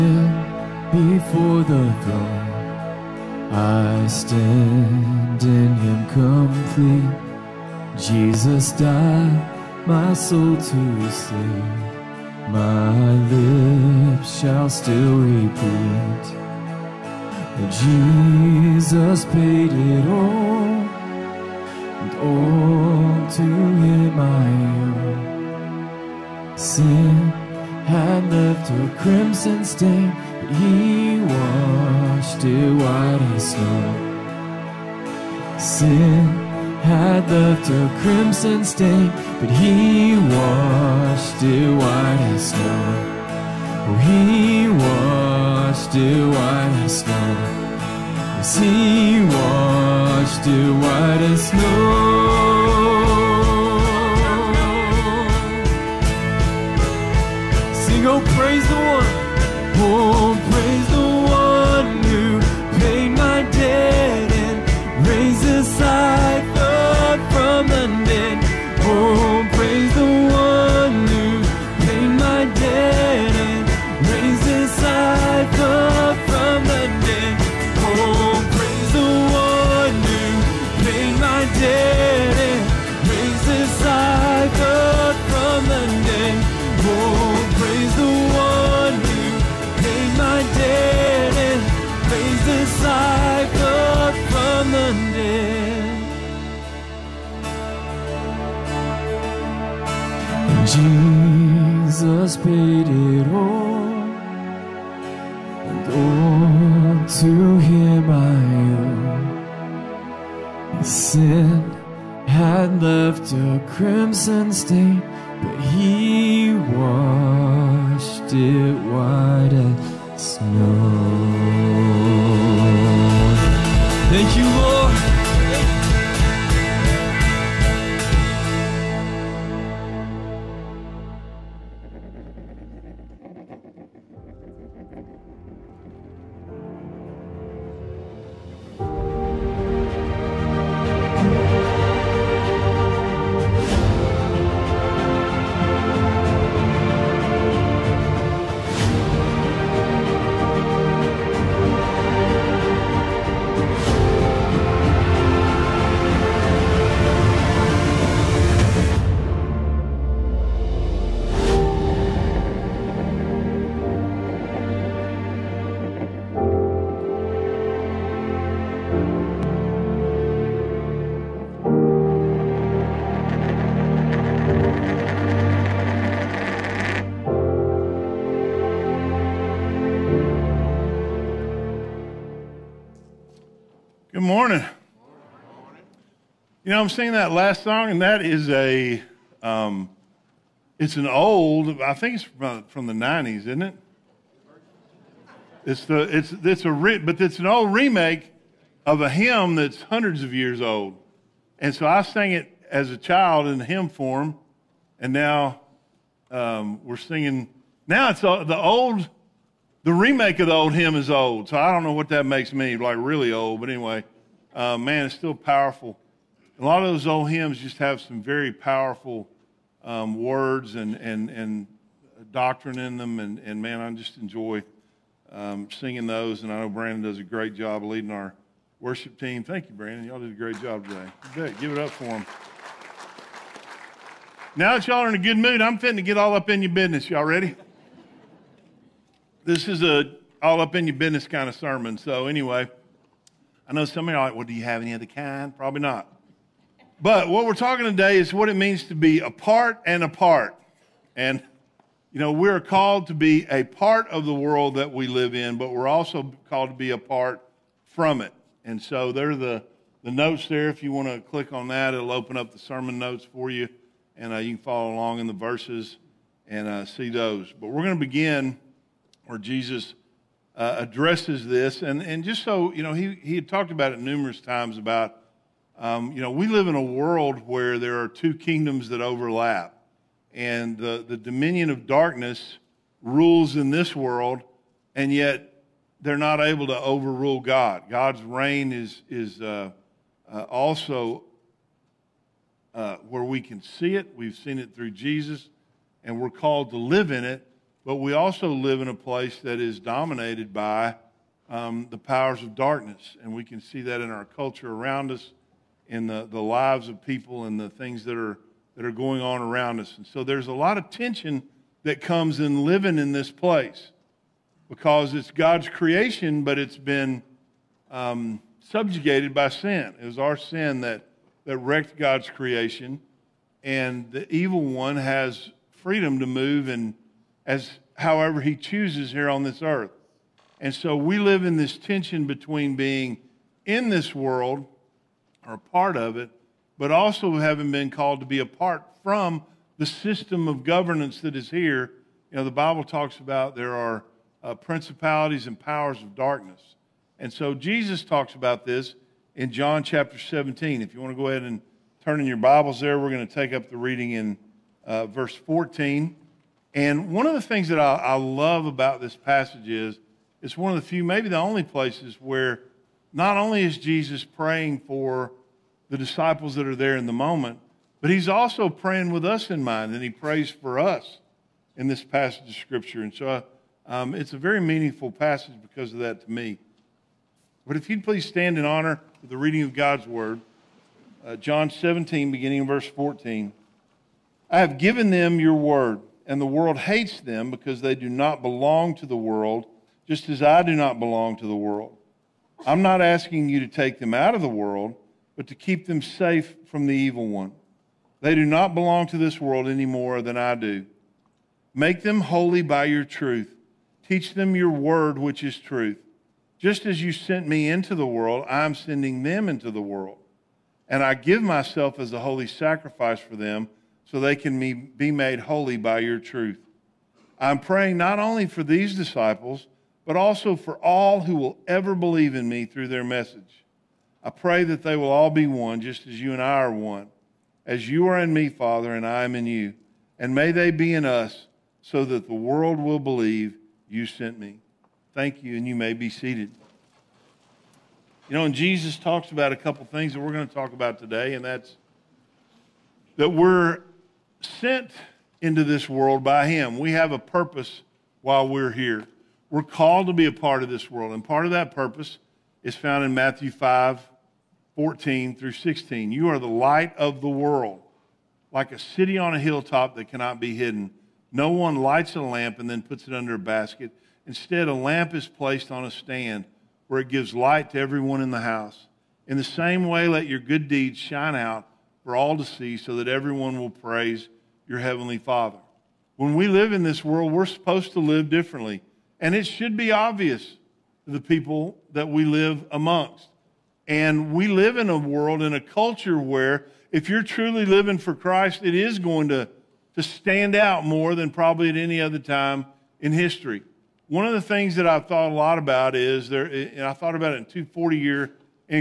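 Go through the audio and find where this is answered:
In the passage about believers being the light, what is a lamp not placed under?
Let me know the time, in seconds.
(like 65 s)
463 s.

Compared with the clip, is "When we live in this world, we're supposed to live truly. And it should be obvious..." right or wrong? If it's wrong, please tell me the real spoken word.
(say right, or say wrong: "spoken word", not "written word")
wrong: "differently", not "truly".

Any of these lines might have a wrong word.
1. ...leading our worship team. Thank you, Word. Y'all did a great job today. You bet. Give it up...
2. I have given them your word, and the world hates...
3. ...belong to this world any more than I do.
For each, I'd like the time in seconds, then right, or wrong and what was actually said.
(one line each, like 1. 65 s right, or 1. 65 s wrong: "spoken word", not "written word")
1. 227 s wrong: "Brandon", not "Word"
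2. 384 s right
3. 398 s right.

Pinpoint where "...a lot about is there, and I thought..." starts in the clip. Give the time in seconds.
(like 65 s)
495 s.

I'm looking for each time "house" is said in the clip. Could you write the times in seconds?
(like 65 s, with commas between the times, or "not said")
468 s.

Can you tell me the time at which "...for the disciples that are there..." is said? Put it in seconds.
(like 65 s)
364 s.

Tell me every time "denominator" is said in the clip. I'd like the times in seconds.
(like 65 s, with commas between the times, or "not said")
not said.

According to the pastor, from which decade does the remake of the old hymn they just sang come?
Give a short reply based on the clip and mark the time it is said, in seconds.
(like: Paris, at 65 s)
the 90s, at 192 s.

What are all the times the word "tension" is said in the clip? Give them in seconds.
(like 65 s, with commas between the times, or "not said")
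310 s, 331 s.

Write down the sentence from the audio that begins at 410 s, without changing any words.
And I give myself as a holy sacrifice for them so they can be made holy by your truth.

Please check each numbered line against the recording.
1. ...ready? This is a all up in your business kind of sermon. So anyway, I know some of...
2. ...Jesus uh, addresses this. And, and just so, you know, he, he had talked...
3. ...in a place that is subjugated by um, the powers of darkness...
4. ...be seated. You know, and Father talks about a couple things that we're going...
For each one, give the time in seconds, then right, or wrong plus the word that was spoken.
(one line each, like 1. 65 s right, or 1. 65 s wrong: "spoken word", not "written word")
1. 237 s right
2. 269 s right
3. 298 s wrong: "dominated", not "subjugated"
4. 435 s wrong: "Jesus", not "Father".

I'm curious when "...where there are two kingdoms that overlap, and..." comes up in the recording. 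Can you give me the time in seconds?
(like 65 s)
277 s.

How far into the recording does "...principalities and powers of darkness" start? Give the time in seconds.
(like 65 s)
344 s.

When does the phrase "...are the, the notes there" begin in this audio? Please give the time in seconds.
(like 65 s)
259 s.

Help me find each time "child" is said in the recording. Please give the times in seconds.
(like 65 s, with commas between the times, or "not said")
202 s.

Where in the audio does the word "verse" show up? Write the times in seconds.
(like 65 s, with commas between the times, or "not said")
265 s, 355 s, 382 s.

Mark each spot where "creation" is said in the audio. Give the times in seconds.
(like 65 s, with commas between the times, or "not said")
315 s, 322 s.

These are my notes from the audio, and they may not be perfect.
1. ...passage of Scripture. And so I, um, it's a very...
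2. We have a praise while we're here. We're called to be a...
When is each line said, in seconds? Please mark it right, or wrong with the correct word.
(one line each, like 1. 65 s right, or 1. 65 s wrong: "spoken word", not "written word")
1. 372 s right
2. 446 s wrong: "purpose", not "praise".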